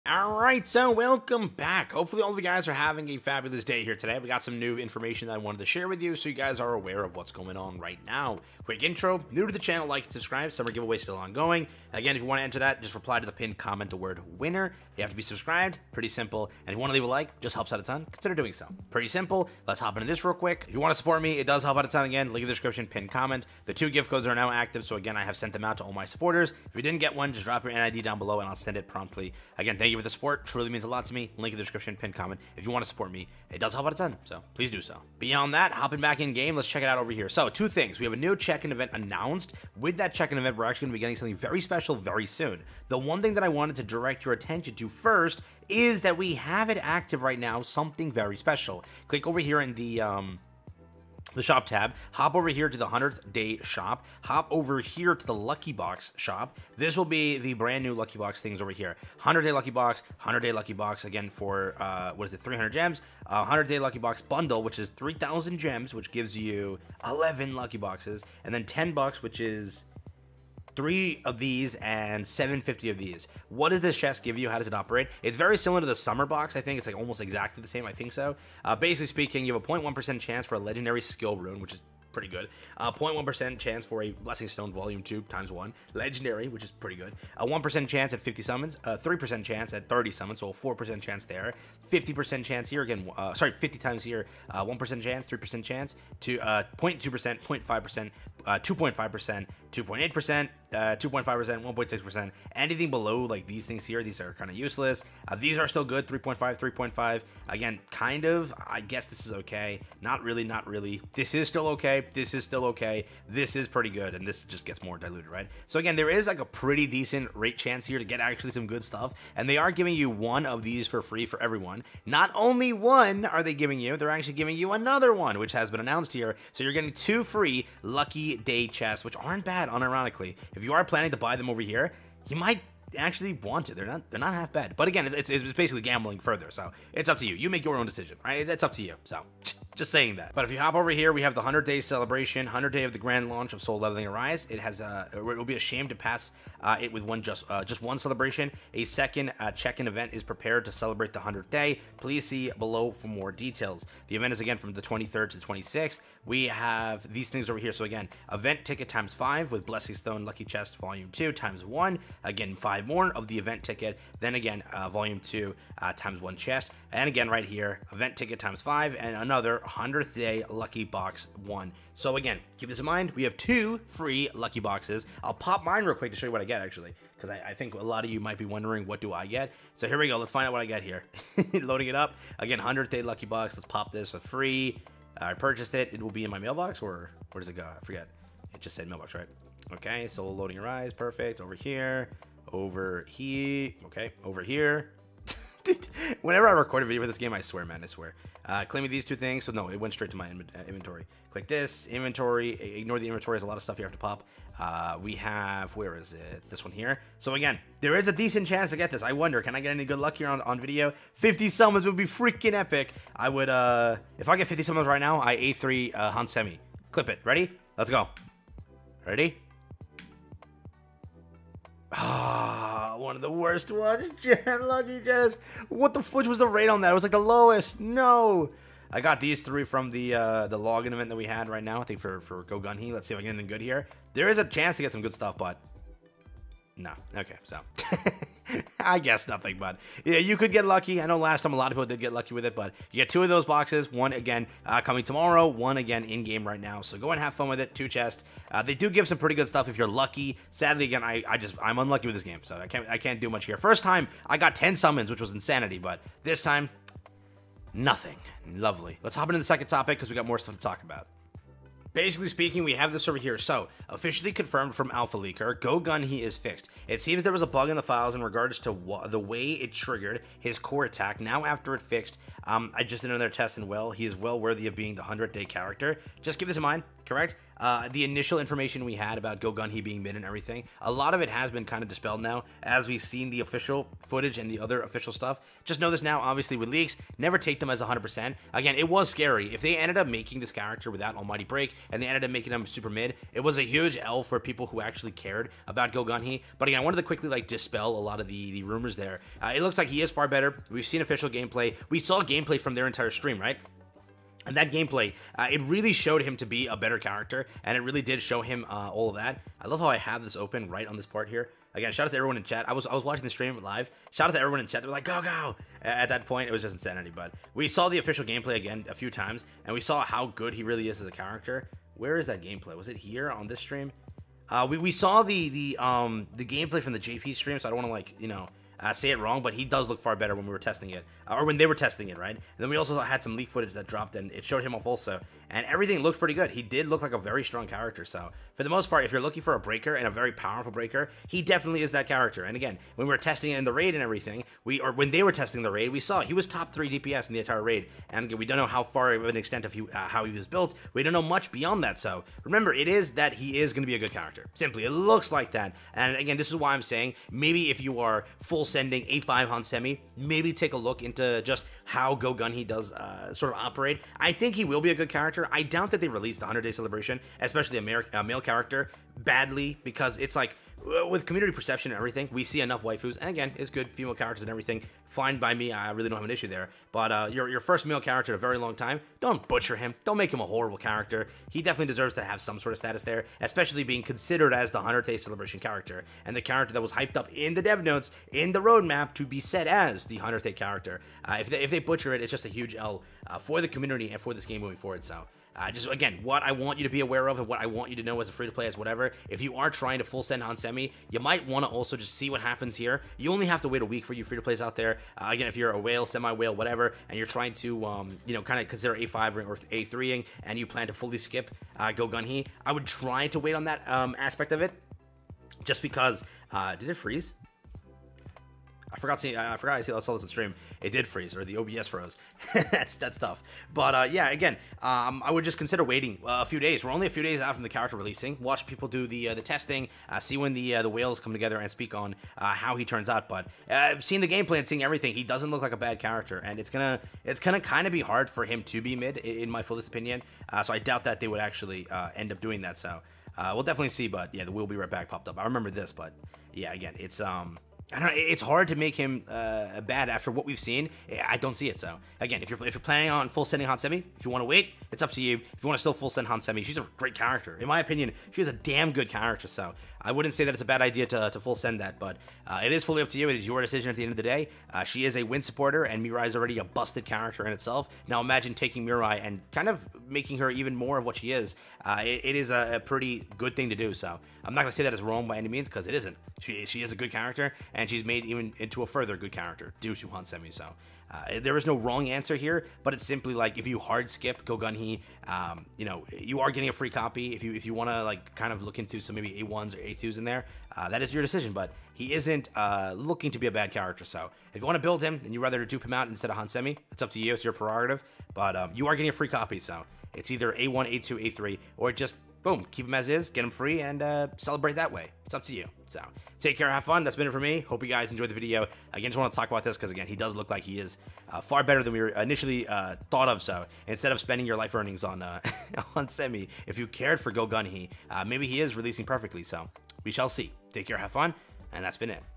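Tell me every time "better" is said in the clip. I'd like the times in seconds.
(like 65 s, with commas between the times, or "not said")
300 s, 306 s, 330 s, 511 s.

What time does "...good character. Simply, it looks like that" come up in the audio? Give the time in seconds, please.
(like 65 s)
353 s.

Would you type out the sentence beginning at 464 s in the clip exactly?
Uh, she is a win supporter, and Mirai is already a busted character in itself.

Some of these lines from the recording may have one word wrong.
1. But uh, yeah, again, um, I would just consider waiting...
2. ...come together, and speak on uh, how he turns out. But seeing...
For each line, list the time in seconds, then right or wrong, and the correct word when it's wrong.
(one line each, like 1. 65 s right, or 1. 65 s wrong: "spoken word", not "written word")
1. 423 s right
2. 431 s right.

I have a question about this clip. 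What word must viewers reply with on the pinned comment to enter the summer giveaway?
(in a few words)
winner.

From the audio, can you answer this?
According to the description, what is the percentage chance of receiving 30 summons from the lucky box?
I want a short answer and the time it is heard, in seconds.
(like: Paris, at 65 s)
3%, at 88 s.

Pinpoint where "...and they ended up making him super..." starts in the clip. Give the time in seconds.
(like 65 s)
291 s.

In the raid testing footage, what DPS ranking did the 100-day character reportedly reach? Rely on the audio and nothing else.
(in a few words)
top three.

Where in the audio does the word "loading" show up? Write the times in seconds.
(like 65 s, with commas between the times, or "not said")
181 s, 190 s.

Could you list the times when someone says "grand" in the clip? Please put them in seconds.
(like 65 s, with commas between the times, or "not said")
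142 s.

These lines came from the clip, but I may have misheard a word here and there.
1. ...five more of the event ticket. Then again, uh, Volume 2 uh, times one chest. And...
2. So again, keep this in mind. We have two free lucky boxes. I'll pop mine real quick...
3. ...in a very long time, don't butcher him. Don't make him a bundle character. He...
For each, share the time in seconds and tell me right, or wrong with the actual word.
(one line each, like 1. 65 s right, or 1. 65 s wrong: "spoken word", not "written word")
1. 162 s right
2. 171 s right
3. 378 s wrong: "horrible", not "bundle".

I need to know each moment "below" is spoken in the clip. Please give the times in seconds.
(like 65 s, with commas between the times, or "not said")
28 s, 102 s, 152 s.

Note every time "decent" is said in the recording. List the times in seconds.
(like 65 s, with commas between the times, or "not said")
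116 s, 208 s.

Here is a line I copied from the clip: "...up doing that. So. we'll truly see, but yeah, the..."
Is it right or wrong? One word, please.
wrong.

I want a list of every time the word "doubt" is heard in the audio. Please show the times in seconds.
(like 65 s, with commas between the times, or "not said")
365 s, 440 s.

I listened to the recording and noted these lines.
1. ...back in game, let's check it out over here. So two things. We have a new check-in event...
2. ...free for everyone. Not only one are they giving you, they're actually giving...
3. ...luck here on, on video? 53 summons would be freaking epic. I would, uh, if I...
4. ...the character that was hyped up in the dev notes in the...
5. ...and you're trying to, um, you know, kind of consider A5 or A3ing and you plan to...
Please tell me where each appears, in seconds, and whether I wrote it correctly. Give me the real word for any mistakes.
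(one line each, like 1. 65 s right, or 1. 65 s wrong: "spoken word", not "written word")
1. 36 s right
2. 121 s right
3. 209 s wrong: "50", not "53"
4. 386 s right
5. 407 s right.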